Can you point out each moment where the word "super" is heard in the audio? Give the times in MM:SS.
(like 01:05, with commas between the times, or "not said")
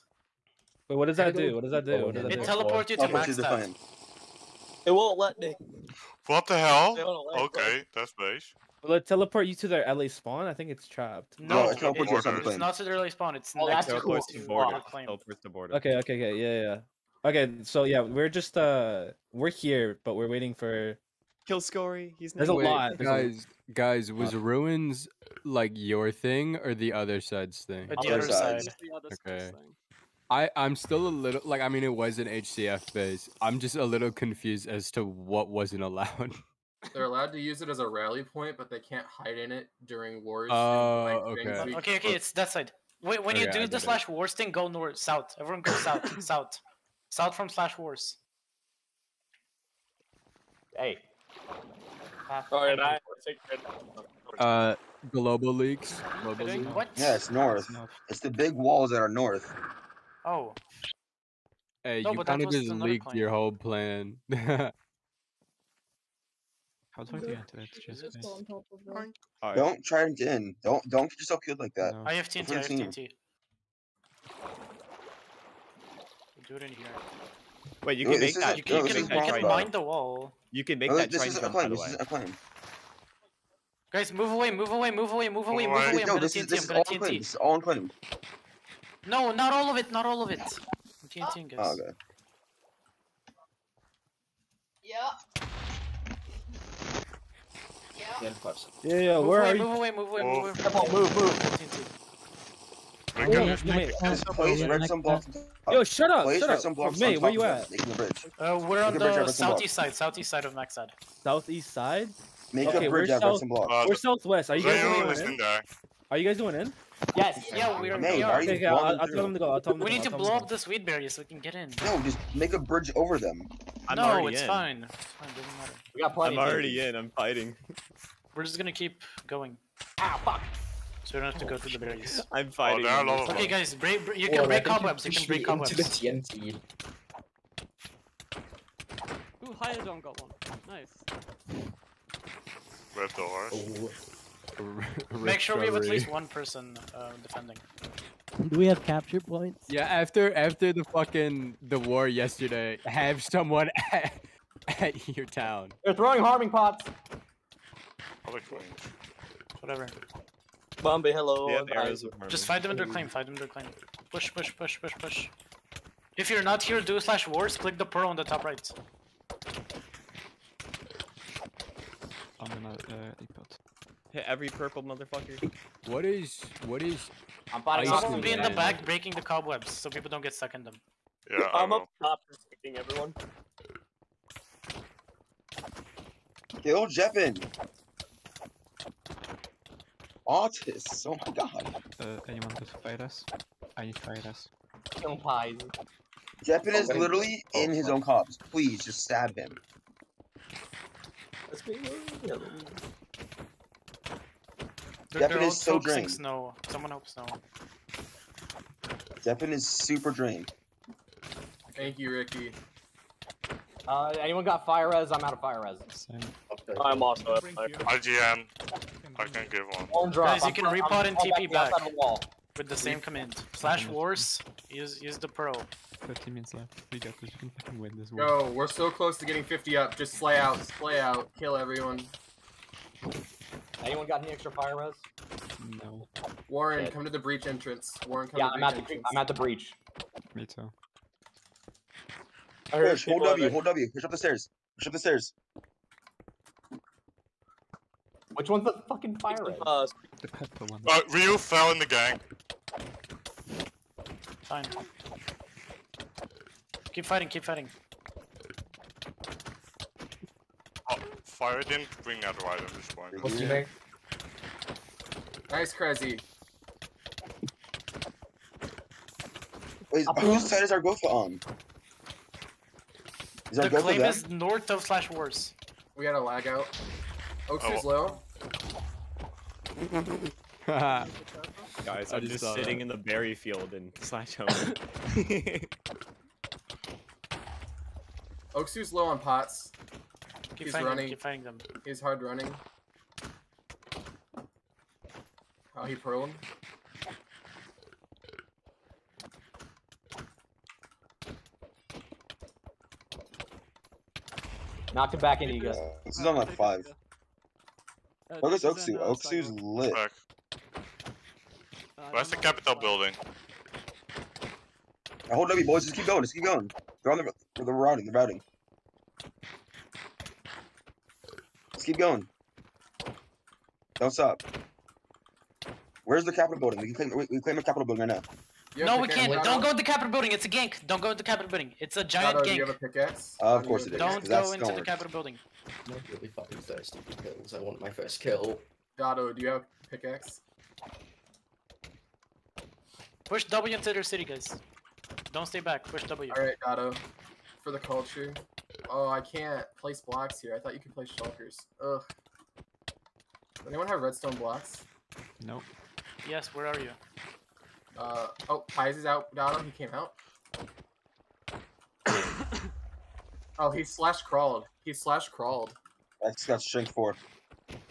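03:29.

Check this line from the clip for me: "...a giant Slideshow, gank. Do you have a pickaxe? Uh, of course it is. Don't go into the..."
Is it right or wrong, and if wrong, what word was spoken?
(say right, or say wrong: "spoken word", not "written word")
wrong: "Shadow", not "Slideshow".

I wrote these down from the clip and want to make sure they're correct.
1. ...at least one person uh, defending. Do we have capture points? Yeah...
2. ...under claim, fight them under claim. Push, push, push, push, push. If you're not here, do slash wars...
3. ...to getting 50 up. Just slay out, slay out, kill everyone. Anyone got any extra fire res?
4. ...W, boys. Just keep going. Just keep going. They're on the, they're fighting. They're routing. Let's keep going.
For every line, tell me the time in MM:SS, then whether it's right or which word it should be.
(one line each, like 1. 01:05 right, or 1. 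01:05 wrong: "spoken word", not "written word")
1. 02:25 right
2. 02:42 right
3. 03:49 right
4. 05:15 wrong: "routing", not "fighting".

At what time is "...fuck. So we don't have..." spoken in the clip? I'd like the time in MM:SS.
02:10.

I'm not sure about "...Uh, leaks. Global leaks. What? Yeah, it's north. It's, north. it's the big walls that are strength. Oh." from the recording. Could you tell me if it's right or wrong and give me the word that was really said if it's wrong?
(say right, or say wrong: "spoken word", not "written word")
wrong: "north", not "strength".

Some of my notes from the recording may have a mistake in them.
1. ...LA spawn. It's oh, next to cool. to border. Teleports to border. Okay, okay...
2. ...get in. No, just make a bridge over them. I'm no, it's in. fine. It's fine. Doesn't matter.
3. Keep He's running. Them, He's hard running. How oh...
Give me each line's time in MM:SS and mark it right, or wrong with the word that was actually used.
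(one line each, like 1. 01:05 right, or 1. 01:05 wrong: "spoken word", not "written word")
1. 00:12 right
2. 02:01 right
3. 04:50 right.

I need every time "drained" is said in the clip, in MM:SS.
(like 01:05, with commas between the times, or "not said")
03:25, 03:30.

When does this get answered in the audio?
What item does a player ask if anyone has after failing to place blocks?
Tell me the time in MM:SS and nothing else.
05:53.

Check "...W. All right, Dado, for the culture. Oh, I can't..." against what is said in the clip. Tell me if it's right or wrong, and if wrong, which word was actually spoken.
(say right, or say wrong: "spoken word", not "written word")
right.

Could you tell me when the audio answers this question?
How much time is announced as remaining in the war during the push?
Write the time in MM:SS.
03:46.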